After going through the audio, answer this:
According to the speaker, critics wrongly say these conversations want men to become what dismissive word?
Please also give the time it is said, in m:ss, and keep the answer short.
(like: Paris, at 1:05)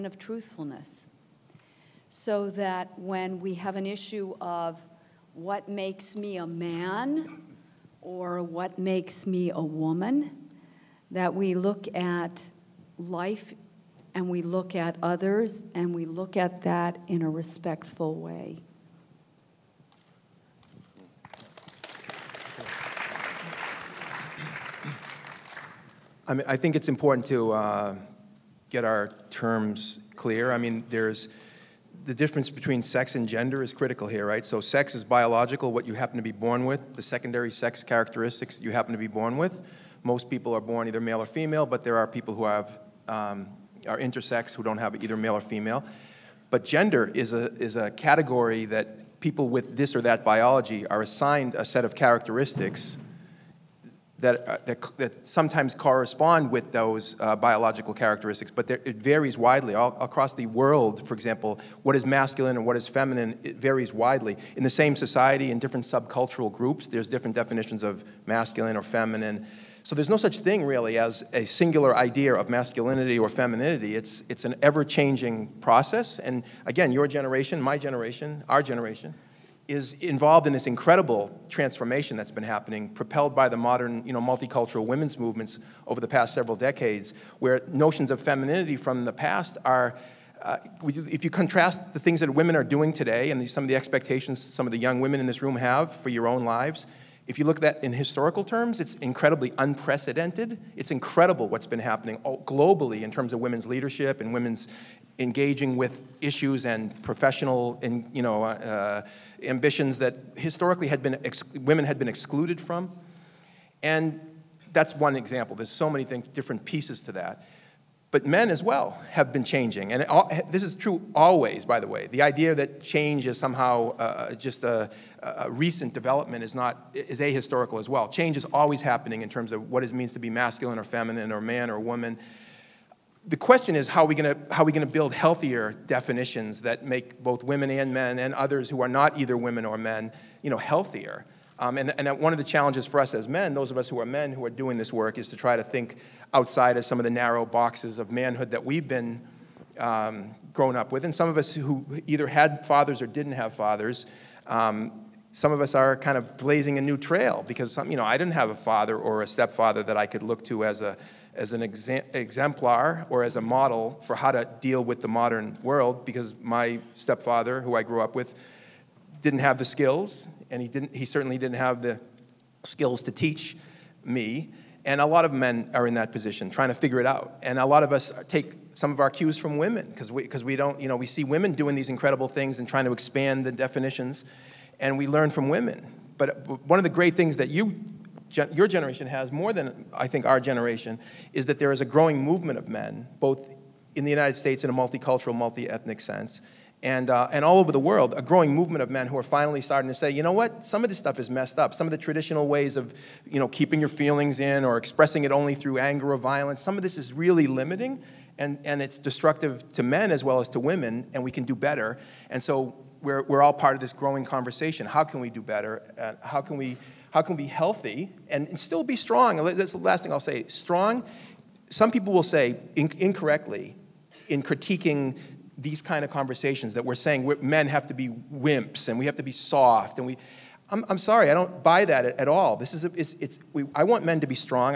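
Wimps, at 3:48.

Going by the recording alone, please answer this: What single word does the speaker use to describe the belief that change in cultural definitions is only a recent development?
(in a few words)
Ahistorical.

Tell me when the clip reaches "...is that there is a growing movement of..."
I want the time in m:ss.
3:11.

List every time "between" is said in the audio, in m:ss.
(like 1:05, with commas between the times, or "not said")
0:32.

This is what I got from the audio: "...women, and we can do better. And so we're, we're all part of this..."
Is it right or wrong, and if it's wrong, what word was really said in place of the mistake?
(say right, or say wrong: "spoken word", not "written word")
right.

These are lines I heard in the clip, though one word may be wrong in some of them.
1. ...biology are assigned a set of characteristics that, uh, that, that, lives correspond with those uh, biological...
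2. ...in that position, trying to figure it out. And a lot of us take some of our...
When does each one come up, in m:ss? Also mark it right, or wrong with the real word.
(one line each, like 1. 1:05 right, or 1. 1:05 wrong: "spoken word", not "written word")
1. 0:50 wrong: "sometimes", not "lives"
2. 2:55 right.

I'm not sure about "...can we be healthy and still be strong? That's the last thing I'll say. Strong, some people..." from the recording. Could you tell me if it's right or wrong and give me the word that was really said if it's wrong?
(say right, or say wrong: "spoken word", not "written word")
right.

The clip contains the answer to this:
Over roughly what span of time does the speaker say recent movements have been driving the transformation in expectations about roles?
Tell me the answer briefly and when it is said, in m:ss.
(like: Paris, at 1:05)
Past several decades, at 1:26.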